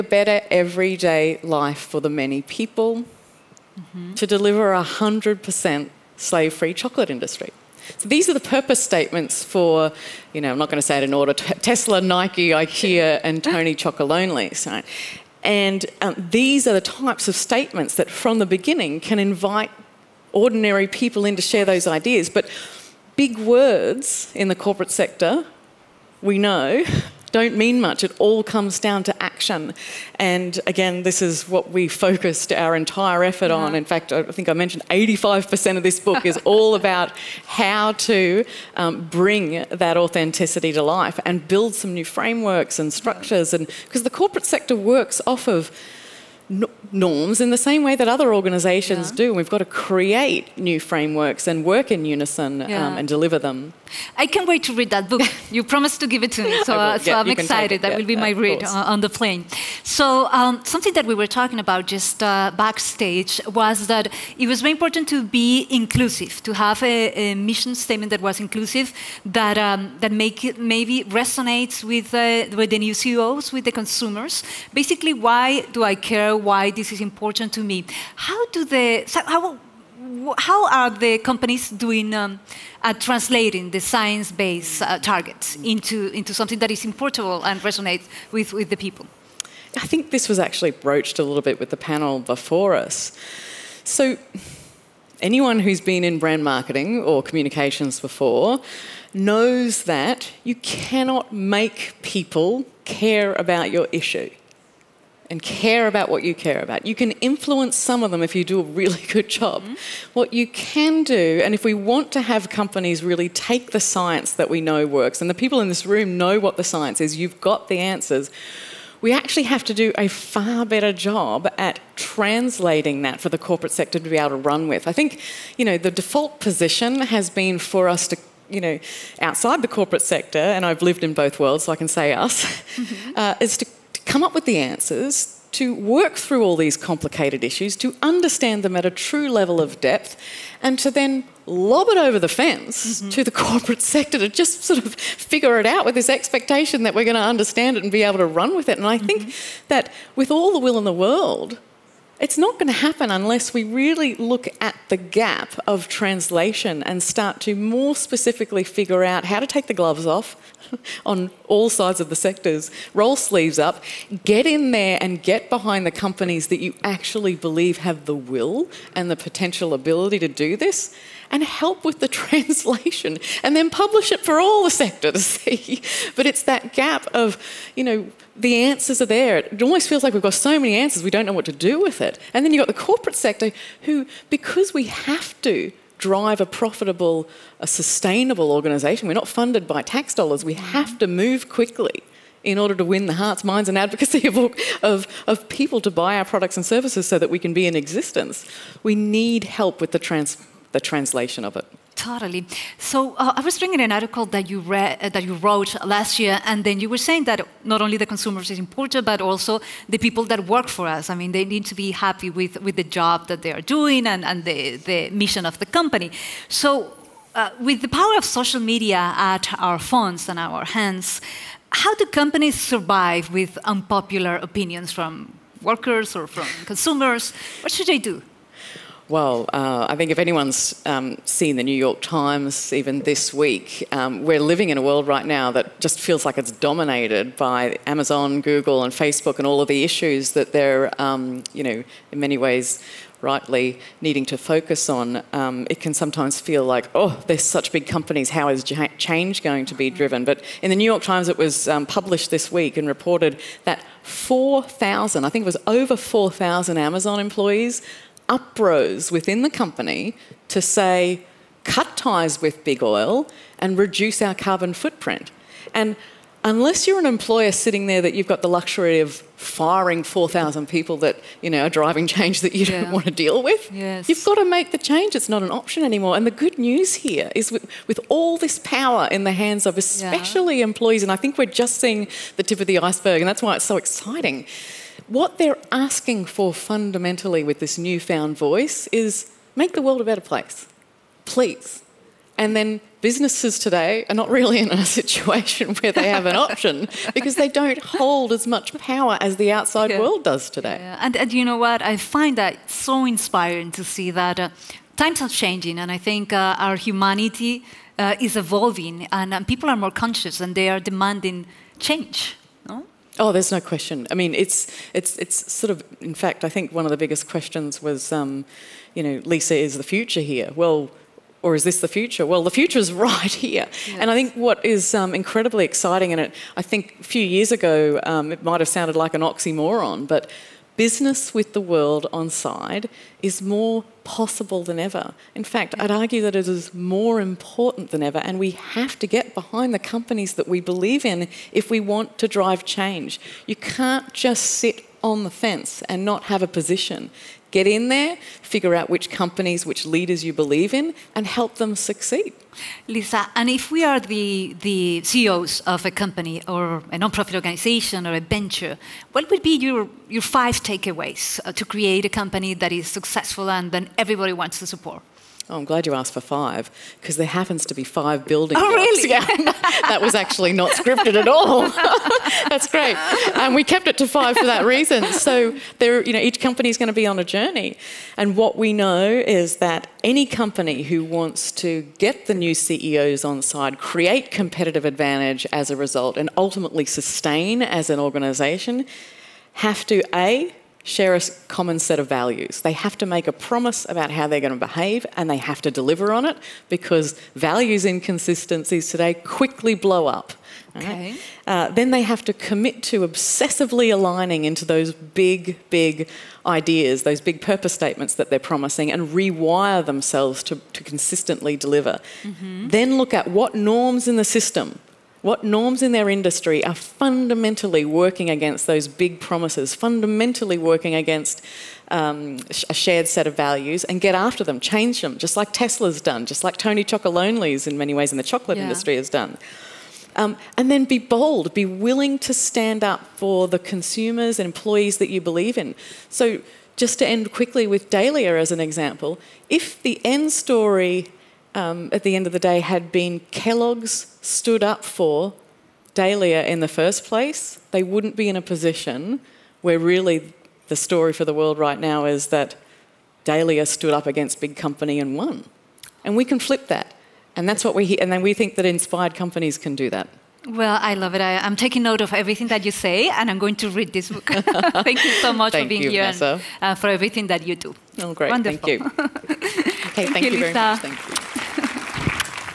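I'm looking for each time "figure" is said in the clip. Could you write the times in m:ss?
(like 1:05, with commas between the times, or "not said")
2:25, 2:38, 5:48.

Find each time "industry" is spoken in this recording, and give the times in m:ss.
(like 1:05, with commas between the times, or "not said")
0:07, 6:56, 7:08.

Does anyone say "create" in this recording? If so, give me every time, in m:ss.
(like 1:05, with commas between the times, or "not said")
0:49, 6:01, 6:23.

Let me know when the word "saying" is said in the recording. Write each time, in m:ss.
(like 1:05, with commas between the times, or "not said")
3:26.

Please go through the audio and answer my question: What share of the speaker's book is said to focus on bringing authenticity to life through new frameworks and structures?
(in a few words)
85%.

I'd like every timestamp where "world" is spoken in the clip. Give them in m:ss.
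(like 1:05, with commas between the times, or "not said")
2:11, 2:31, 3:54, 4:49, 4:59, 5:31, 7:31.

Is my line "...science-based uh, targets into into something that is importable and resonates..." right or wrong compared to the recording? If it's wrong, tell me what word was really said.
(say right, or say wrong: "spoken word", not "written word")
right.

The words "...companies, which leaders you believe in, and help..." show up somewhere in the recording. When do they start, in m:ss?
5:49.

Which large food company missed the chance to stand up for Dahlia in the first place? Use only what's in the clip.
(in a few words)
Kellogg's.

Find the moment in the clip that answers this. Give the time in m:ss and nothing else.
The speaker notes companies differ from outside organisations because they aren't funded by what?
3:09.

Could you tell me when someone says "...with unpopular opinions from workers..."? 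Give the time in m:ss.
3:43.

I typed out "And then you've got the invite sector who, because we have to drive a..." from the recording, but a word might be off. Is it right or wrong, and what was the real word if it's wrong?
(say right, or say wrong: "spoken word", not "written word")
wrong: "corporate", not "invite".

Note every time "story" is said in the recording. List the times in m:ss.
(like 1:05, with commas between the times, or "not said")
7:20, 7:30.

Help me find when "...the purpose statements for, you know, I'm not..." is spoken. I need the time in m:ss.
0:08.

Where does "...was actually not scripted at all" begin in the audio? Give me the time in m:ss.
6:10.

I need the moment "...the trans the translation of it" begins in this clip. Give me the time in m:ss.
3:19.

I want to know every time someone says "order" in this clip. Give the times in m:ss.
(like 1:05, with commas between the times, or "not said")
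0:11, 3:12.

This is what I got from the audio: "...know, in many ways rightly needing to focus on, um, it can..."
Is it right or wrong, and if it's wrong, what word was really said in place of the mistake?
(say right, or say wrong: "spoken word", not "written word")
right.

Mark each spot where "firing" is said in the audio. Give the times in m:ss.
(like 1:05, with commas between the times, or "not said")
4:29.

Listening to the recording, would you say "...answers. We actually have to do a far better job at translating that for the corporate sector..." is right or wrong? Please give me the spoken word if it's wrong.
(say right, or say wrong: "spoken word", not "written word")
right.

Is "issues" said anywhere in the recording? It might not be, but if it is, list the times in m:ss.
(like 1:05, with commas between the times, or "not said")
1:43, 2:17, 3:59.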